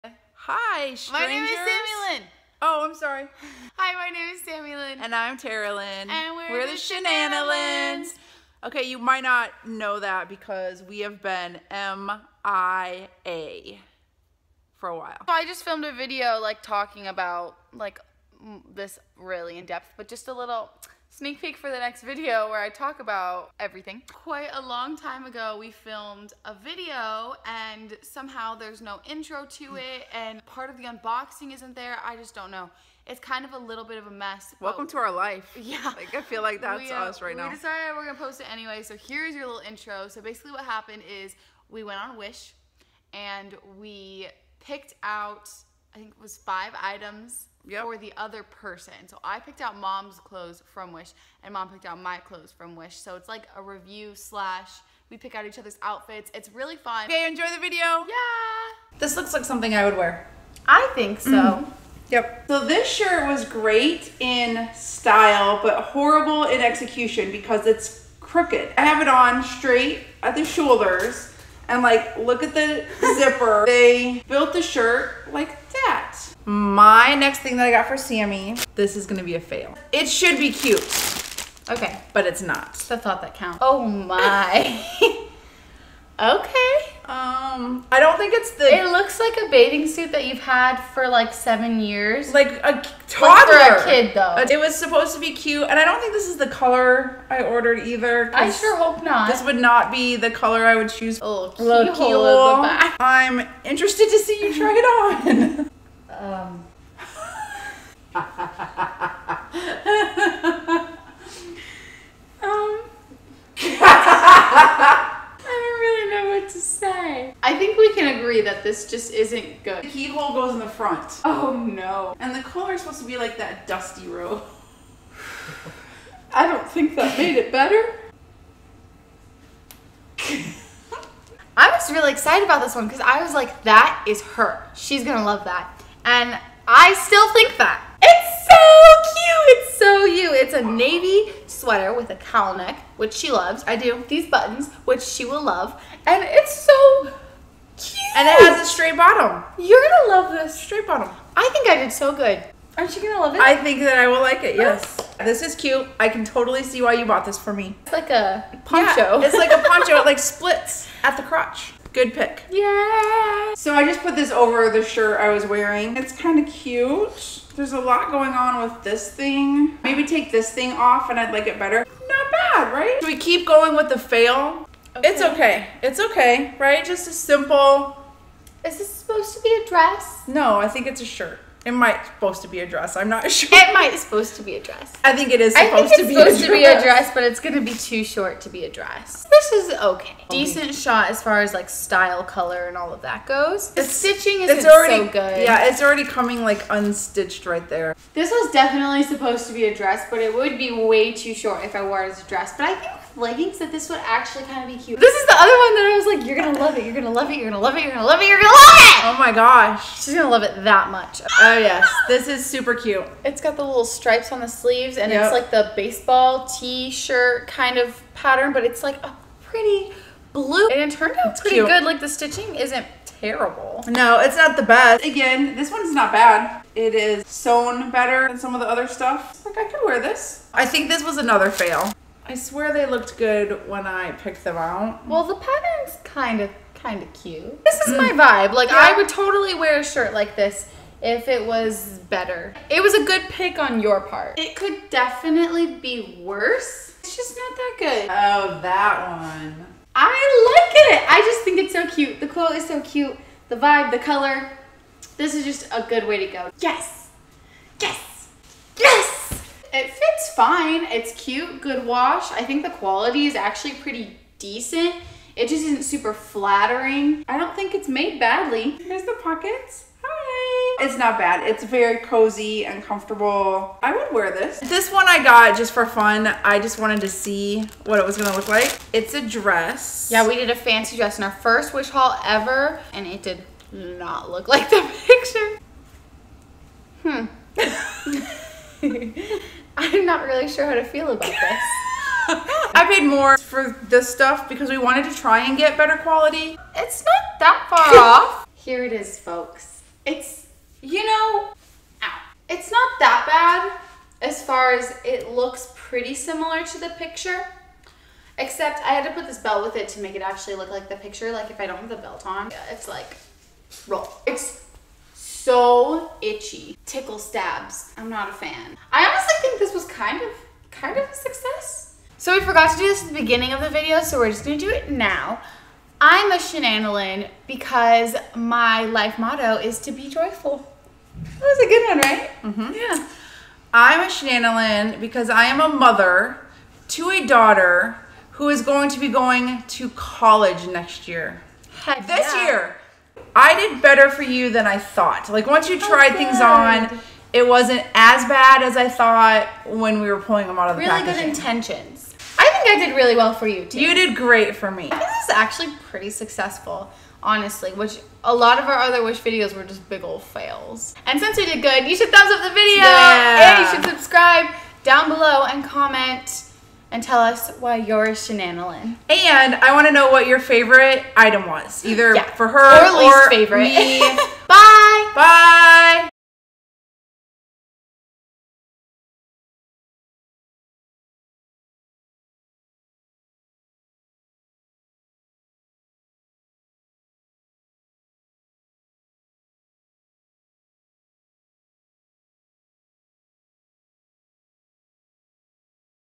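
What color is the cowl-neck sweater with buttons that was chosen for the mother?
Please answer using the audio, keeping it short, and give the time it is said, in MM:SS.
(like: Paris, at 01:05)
Navy, at 02:20.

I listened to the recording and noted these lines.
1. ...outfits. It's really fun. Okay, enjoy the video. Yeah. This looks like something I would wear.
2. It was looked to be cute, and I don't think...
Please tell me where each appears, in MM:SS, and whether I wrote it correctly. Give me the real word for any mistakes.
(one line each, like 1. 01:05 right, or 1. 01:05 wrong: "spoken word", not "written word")
1. 00:55 right
2. 01:34 wrong: "supposed", not "looked".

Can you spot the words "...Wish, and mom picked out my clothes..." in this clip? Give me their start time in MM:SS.
00:50.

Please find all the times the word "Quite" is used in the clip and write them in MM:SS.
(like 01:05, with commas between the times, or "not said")
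00:24.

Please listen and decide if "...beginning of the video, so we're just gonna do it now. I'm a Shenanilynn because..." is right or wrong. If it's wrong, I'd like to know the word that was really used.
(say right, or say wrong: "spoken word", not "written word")
right.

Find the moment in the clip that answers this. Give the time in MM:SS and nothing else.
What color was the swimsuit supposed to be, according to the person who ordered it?
02:03.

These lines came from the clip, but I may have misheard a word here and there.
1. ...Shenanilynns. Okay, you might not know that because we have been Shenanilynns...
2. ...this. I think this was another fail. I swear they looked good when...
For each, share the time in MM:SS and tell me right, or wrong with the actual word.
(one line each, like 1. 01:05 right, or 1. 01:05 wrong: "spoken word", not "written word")
1. 00:06 wrong: "MIA", not "Shenanilynns"
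2. 03:49 right.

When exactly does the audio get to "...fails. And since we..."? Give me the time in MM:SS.
06:00.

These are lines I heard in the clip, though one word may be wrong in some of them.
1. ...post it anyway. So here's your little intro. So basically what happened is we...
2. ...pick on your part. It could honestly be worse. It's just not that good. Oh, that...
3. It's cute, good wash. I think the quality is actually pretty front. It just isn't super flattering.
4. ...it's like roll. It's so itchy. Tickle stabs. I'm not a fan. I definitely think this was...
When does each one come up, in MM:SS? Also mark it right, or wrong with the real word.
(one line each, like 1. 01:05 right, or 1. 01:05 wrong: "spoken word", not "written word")
1. 00:38 right
2. 04:03 wrong: "definitely", not "honestly"
3. 04:20 wrong: "decent", not "front"
4. 05:12 wrong: "honestly", not "definitely".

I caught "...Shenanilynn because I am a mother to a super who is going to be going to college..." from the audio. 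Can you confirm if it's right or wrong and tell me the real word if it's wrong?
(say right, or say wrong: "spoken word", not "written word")
wrong: "daughter", not "super".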